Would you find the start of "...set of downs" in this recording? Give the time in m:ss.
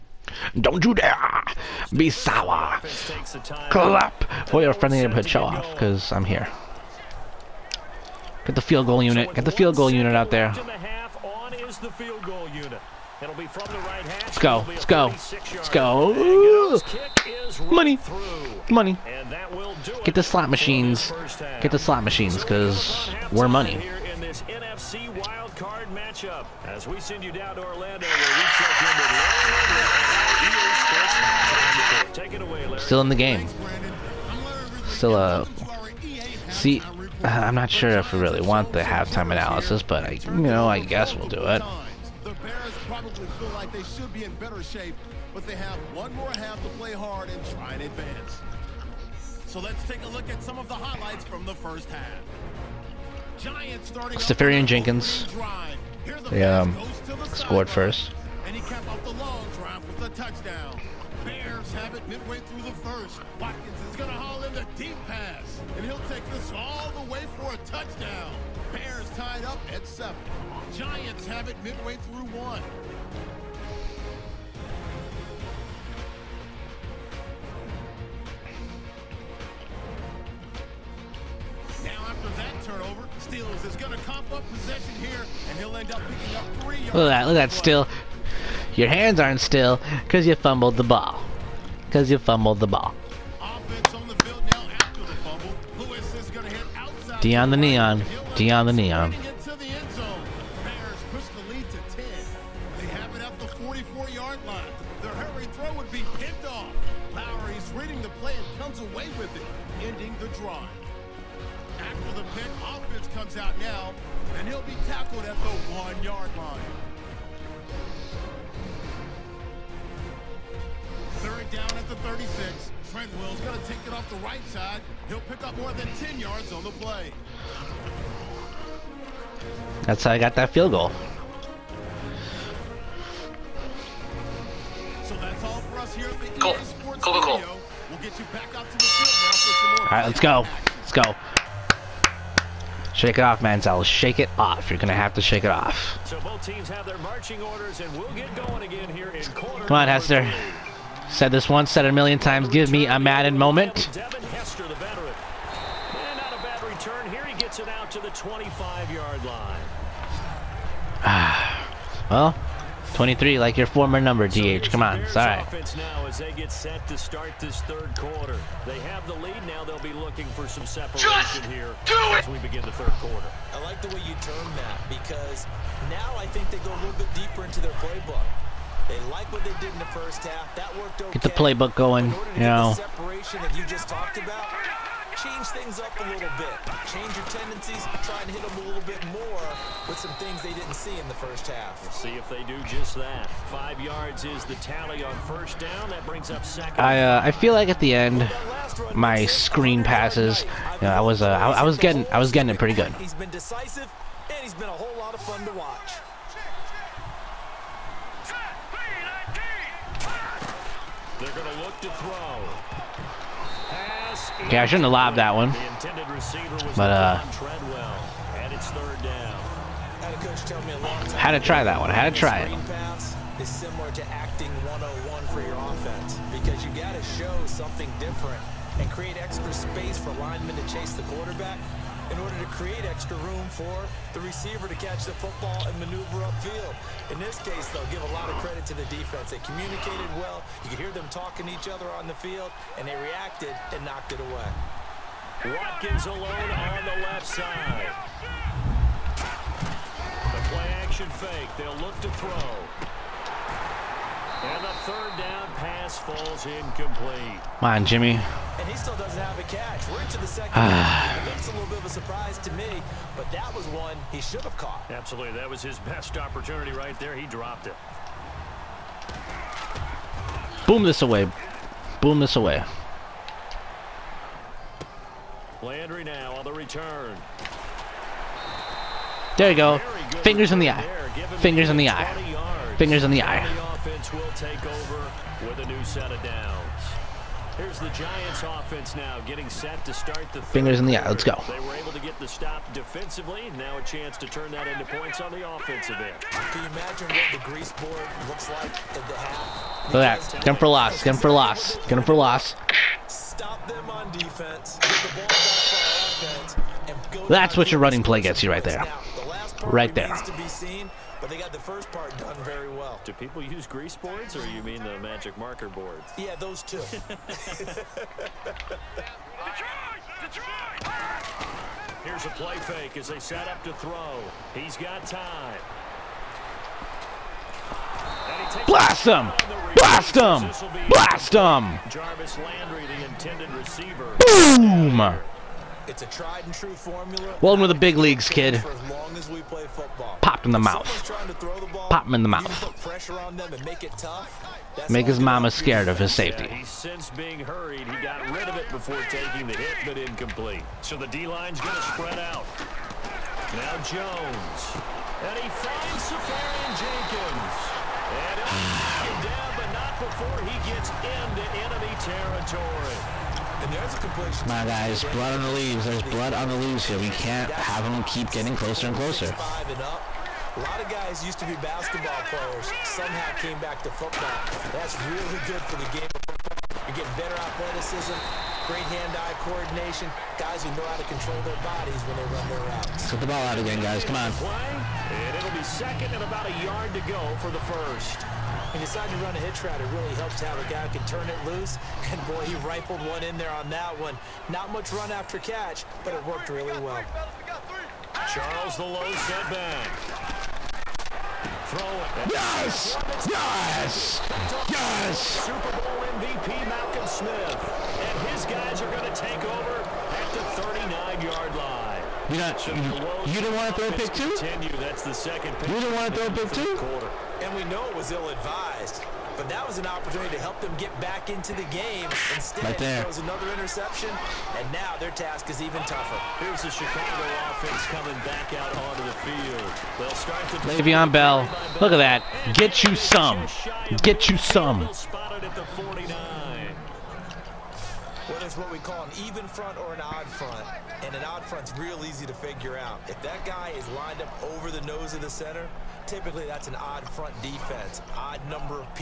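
4:45.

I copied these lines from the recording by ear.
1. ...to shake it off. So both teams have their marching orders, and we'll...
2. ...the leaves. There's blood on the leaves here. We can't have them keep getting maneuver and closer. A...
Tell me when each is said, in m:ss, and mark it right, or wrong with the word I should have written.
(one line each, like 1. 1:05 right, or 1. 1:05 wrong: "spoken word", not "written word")
1. 2:25 right
2. 6:05 wrong: "closer", not "maneuver".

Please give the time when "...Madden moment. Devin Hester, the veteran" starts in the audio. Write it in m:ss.
2:32.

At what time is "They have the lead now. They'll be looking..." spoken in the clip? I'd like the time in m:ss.
2:45.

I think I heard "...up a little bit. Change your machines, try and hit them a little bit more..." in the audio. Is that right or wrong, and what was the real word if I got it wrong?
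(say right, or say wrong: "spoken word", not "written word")
wrong: "tendencies", not "machines".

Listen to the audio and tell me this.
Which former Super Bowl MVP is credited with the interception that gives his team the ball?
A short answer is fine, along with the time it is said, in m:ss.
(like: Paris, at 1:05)
Malcolm Smith, at 6:46.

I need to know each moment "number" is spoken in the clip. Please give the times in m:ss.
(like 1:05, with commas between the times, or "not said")
2:44, 7:28.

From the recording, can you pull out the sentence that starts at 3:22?
He's been decisive, and he's been a whole lot of fun to watch.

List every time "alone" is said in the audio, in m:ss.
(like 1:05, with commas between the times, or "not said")
4:06.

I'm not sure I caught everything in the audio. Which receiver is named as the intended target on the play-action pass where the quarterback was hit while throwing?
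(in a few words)
Jarvis Landry.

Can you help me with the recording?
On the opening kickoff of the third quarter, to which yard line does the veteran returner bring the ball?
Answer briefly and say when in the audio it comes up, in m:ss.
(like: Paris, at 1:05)
25-yard line, at 2:38.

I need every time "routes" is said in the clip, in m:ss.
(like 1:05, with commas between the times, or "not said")
6:22, 6:29.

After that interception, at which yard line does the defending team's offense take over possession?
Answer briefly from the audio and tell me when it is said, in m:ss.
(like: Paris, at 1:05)
39-yard line, at 6:50.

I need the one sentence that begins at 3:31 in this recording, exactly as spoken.
They're going to look to throw.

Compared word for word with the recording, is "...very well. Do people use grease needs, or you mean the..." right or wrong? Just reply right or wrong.
wrong.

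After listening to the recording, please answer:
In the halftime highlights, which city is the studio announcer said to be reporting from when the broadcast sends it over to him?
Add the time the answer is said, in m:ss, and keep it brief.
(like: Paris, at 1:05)
Orlando, at 0:27.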